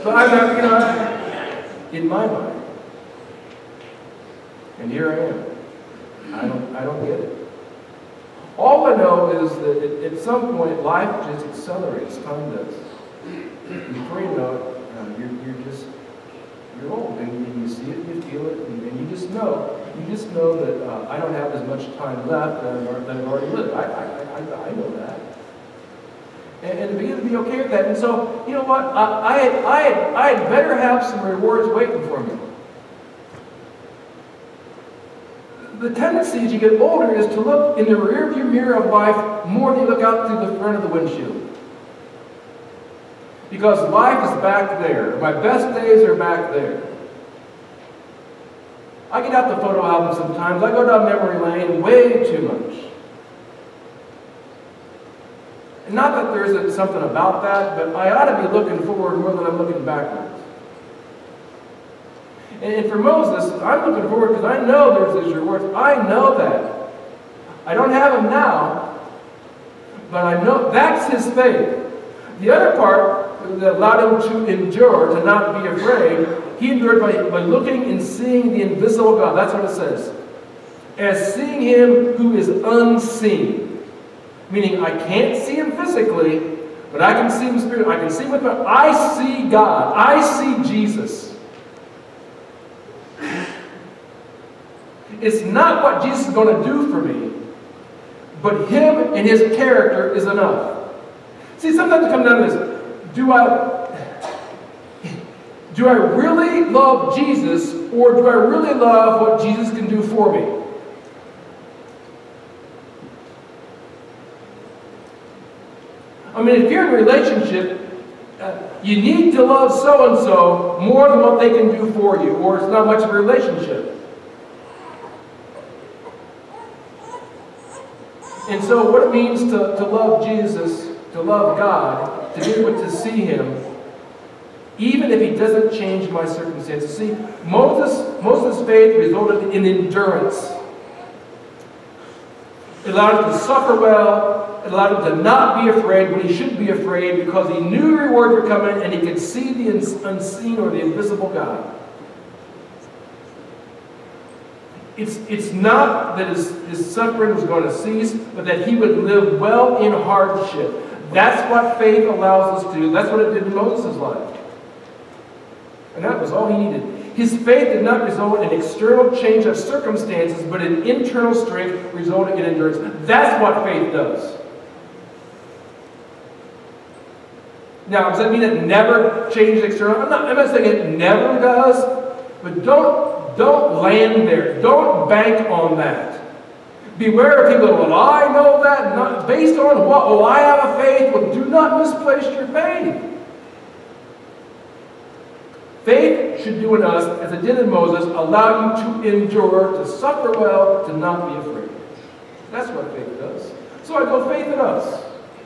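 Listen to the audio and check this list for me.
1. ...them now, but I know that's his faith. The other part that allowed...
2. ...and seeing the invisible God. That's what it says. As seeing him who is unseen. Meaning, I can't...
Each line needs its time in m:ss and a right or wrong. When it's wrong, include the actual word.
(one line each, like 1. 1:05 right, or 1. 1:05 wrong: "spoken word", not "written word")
1. 1:08 right
2. 1:17 right.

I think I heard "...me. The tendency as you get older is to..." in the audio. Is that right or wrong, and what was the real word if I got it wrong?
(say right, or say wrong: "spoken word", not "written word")
right.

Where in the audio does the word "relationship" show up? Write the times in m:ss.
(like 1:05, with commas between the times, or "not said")
1:56, 2:03.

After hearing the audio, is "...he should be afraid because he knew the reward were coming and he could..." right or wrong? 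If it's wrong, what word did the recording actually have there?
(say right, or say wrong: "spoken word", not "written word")
right.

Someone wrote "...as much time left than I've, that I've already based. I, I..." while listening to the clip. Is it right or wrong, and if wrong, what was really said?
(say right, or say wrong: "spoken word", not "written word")
wrong: "lived", not "based".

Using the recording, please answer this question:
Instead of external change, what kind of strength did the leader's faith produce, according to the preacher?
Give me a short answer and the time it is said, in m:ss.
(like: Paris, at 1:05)
Internal strength, at 2:50.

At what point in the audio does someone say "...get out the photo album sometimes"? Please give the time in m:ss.
0:49.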